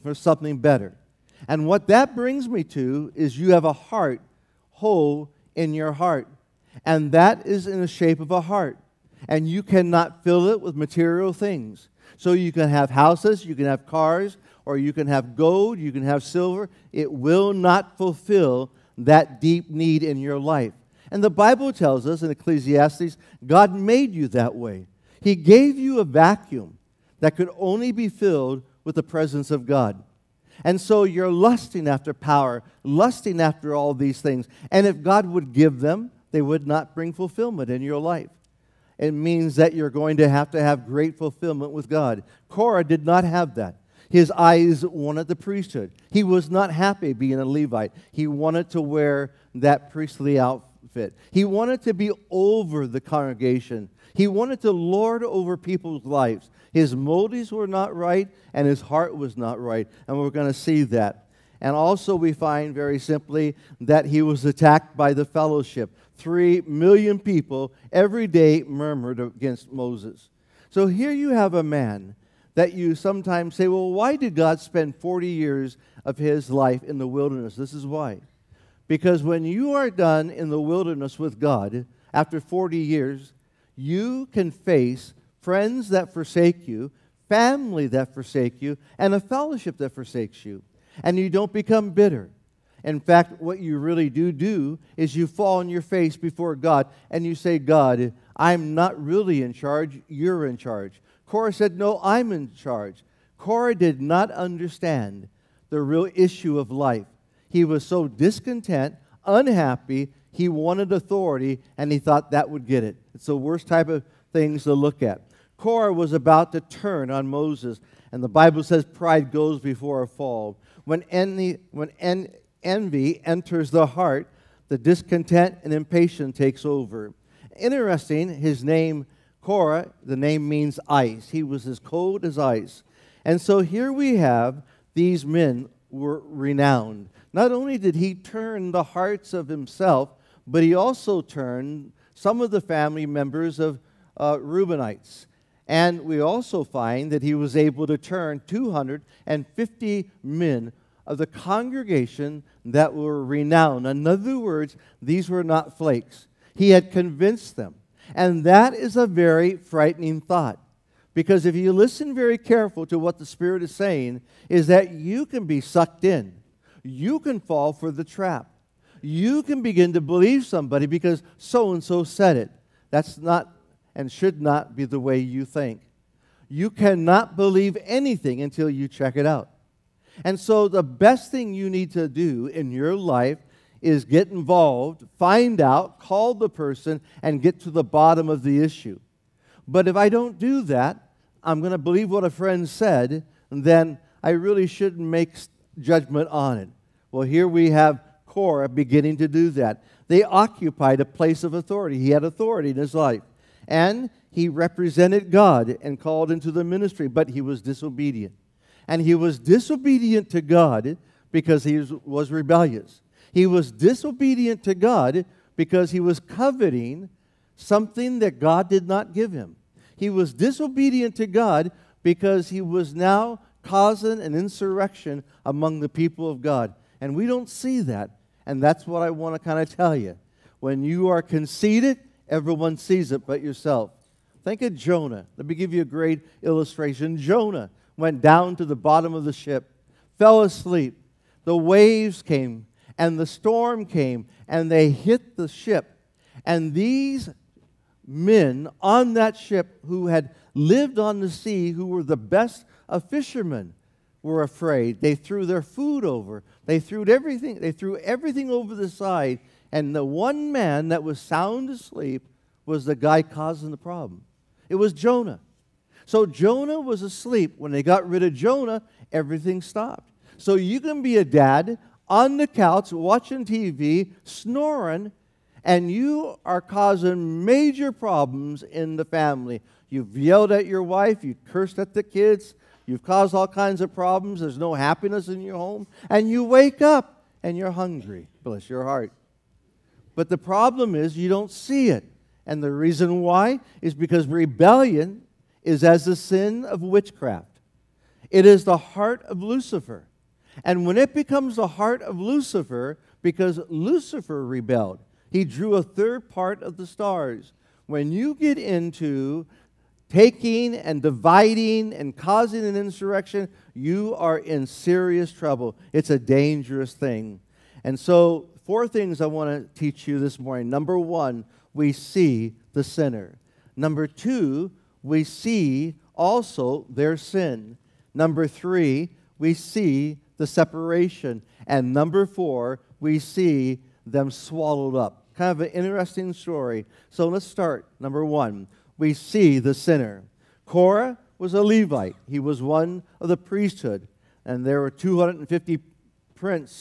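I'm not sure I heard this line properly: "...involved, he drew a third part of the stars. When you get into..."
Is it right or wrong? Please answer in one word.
wrong.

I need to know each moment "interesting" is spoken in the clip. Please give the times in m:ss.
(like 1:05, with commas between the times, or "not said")
2:07, 5:35.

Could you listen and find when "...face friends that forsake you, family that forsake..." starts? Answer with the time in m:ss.
1:24.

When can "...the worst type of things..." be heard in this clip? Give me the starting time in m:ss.
1:53.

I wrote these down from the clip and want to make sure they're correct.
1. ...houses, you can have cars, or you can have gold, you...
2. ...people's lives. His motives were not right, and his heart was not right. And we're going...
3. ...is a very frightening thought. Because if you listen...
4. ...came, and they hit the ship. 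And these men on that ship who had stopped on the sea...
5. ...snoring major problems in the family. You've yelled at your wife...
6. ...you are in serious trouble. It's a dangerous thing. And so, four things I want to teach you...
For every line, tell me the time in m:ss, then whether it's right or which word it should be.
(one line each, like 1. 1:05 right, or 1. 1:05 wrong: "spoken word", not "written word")
1. 0:12 right
2. 0:55 right
3. 2:38 right
4. 4:03 wrong: "lived", not "stopped"
5. 4:36 wrong: "causing", not "snoring"
6. 5:13 right.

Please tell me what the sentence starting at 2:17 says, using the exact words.
Not only did he turn the hearts of himself, but he also turned some of the family members of uh, Reubenites.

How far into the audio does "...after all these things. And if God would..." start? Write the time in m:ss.
0:33.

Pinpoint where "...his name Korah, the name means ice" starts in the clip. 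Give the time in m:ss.
2:08.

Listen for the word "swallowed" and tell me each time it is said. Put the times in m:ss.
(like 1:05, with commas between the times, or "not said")
5:34.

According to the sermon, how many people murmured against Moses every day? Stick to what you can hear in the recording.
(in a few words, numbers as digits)
3 million.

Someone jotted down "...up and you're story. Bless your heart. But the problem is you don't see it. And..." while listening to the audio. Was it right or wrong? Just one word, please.
wrong.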